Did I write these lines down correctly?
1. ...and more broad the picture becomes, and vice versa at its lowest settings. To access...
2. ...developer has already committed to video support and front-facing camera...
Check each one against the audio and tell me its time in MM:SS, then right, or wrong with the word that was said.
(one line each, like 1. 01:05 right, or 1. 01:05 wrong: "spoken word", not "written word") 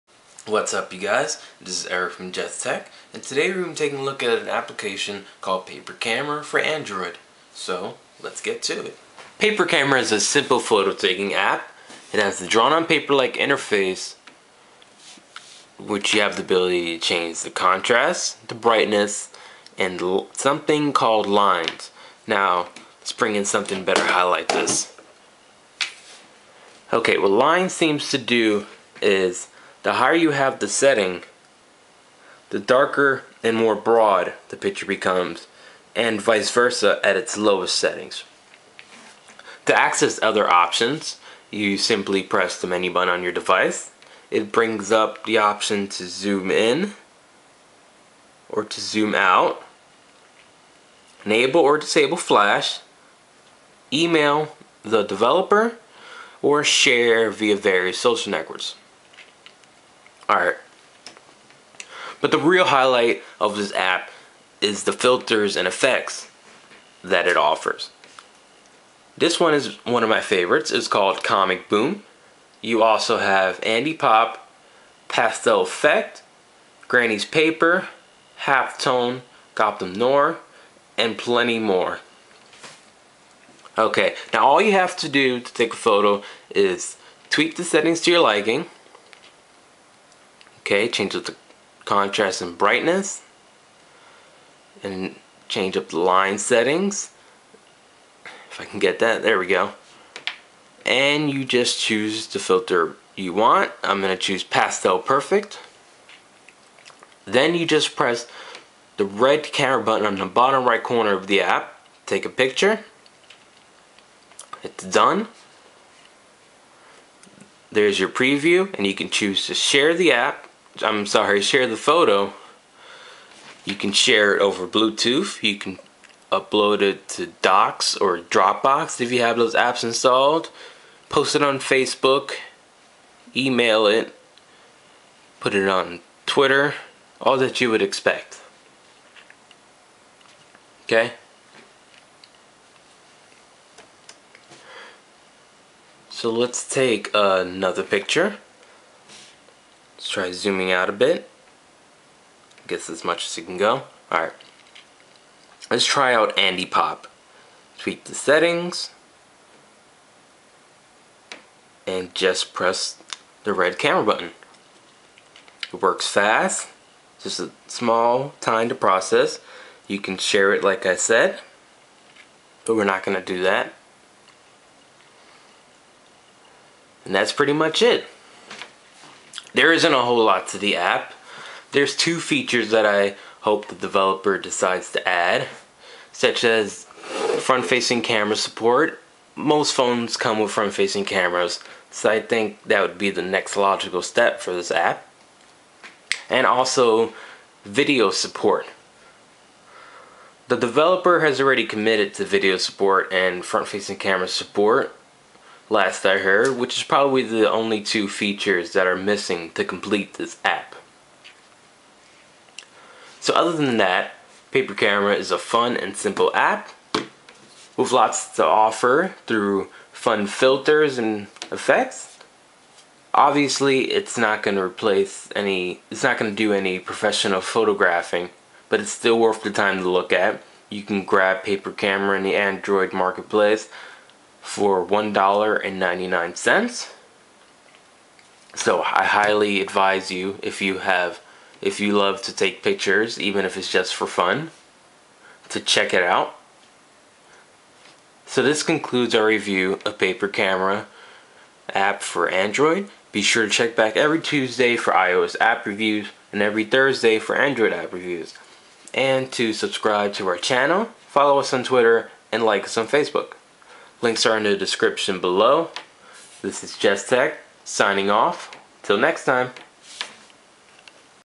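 1. 00:33 right
2. 03:20 right.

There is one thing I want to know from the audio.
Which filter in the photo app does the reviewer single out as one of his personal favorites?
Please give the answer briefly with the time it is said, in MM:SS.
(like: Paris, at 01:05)
Comic Boom, at 01:11.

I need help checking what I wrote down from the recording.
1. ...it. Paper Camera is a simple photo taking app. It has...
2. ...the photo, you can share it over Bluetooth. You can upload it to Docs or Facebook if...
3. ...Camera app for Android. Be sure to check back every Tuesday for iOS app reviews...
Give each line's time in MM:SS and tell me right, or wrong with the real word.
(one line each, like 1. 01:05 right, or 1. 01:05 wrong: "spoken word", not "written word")
1. 00:08 right
2. 02:01 wrong: "Dropbox", not "Facebook"
3. 04:10 right.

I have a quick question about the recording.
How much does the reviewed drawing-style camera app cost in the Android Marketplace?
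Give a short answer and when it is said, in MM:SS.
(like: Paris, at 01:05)
$1.99, at 03:54.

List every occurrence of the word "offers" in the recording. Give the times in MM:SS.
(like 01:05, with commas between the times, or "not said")
01:07, 03:38.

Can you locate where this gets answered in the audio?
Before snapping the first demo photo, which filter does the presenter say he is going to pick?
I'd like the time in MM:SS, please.
01:44.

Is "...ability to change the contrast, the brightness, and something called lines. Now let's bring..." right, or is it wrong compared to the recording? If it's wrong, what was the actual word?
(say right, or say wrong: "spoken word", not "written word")
right.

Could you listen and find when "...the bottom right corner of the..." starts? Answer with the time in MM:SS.
01:50.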